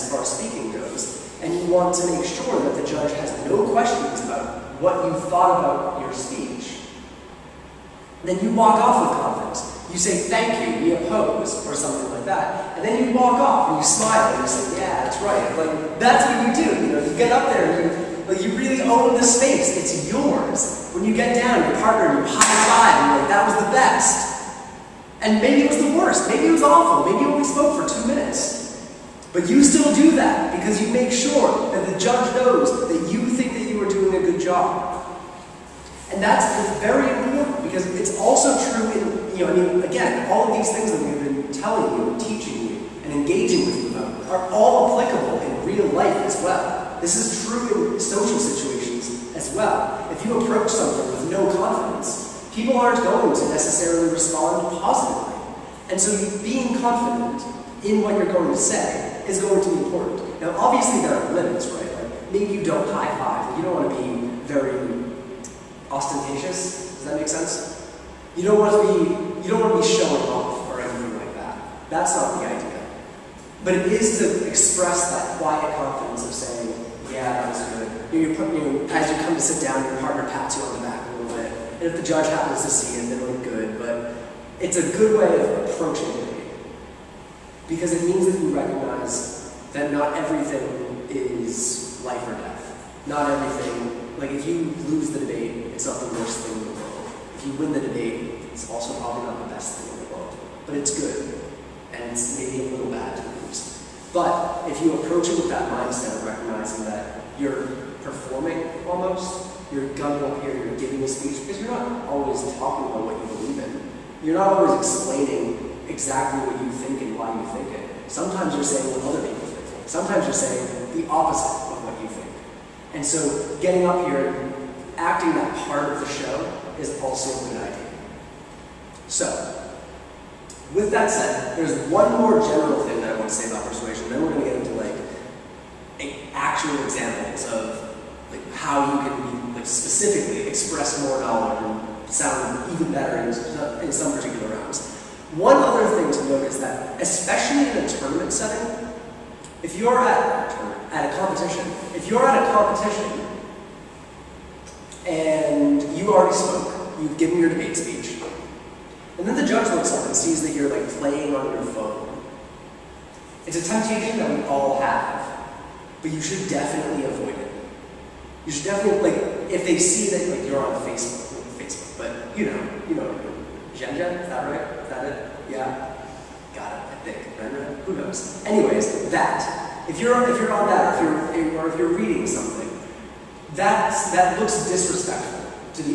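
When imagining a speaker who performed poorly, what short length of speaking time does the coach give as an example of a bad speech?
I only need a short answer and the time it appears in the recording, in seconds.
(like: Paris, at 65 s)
2 minutes, at 27 s.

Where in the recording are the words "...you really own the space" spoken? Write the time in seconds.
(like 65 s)
18 s.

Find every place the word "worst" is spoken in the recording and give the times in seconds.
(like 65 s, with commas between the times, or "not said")
25 s, 96 s.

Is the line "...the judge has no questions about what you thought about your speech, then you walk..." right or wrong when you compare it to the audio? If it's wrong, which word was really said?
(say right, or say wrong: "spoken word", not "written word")
right.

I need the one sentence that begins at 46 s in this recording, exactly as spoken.
This is true in social situations as well.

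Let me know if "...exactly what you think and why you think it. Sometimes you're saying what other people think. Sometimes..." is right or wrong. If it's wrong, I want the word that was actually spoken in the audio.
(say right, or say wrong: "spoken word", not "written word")
right.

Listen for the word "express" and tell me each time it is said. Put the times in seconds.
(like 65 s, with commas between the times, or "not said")
74 s, 140 s.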